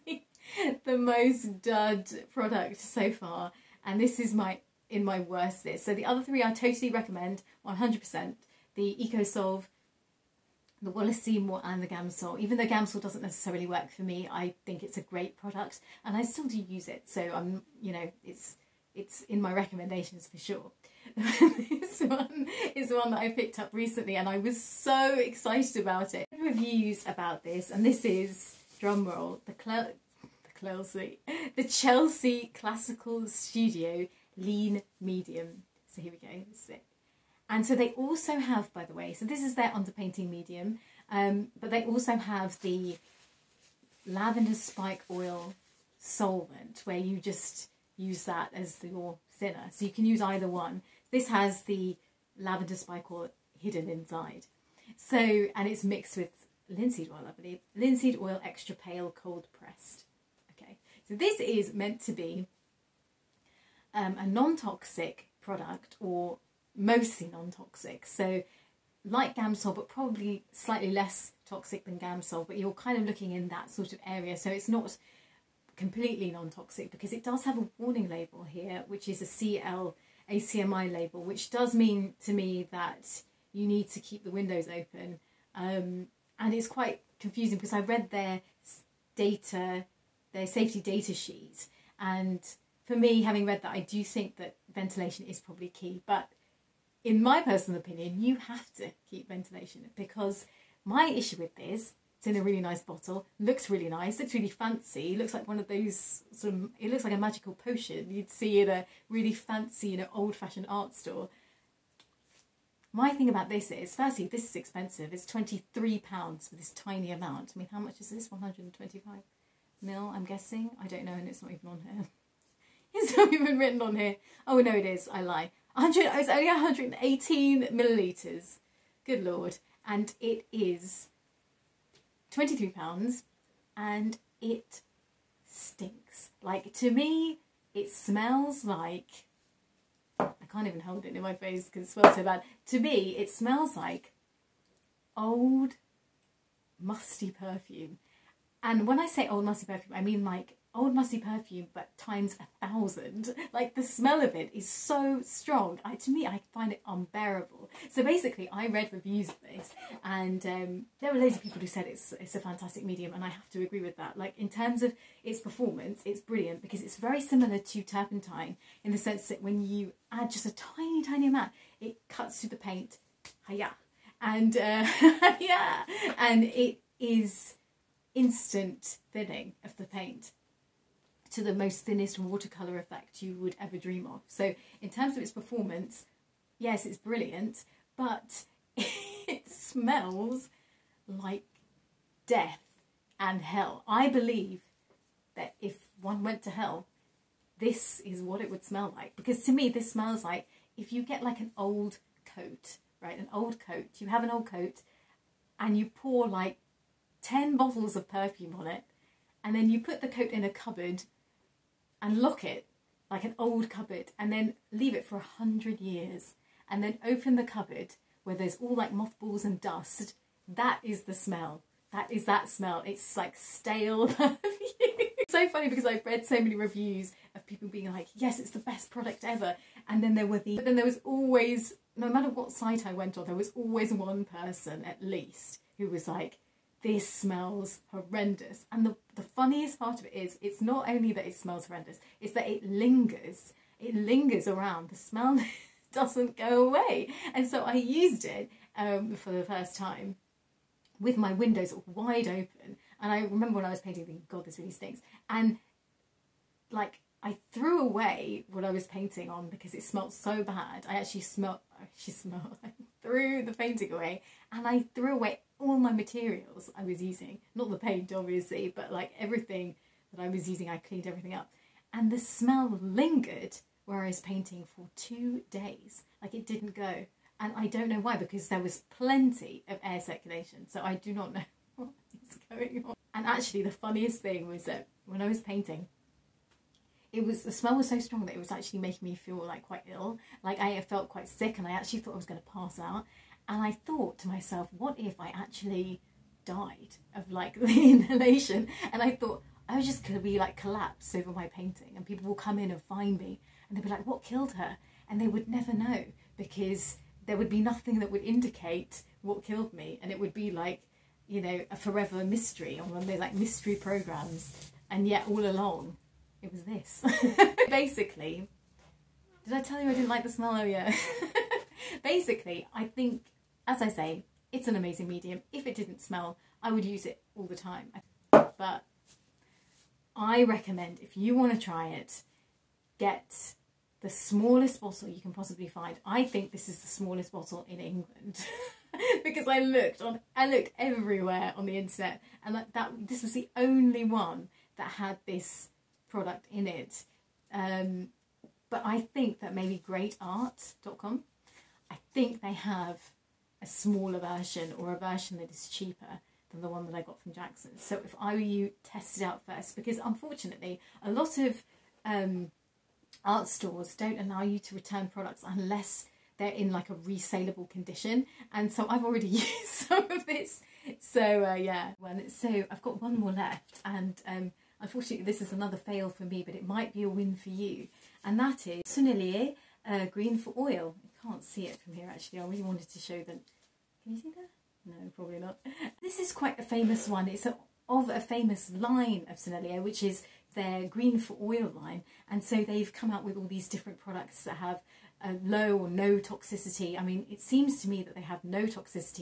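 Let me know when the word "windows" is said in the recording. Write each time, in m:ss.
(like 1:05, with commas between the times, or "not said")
1:24, 4:11.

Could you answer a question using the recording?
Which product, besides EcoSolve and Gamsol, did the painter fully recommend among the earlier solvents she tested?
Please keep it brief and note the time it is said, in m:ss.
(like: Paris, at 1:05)
Wallace Seymour, at 0:10.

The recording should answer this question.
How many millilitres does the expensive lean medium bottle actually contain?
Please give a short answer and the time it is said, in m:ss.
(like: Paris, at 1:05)
118 ml, at 2:06.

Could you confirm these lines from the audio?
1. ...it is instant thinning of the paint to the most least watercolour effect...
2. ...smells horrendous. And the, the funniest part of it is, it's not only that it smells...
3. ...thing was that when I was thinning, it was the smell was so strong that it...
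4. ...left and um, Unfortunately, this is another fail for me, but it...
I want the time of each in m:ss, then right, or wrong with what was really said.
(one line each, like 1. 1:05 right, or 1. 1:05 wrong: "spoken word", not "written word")
1. 2:56 wrong: "thinnest", not "least"
2. 3:57 right
3. 4:44 wrong: "painting", not "thinning"
4. 6:13 right.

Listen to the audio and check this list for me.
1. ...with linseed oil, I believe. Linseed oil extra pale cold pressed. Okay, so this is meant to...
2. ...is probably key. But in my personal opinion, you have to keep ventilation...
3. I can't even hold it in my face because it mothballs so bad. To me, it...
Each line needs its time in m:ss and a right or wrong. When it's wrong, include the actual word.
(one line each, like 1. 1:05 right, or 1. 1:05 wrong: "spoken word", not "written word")
1. 0:56 right
2. 1:35 right
3. 2:20 wrong: "smells", not "mothballs".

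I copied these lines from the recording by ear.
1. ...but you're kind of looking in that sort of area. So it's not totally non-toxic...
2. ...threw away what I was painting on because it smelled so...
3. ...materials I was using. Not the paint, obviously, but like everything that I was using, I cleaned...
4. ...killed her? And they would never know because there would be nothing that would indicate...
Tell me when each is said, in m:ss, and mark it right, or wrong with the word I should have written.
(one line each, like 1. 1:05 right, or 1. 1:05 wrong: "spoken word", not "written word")
1. 1:12 wrong: "completely", not "totally"
2. 4:17 right
3. 4:25 right
4. 5:04 right.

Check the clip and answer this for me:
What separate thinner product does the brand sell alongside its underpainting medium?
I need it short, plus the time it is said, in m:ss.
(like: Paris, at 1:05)
lavender spike oil solvent, at 0:44.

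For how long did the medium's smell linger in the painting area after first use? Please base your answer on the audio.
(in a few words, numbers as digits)
two days.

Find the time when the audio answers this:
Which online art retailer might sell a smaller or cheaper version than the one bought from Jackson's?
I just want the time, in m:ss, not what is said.
5:49.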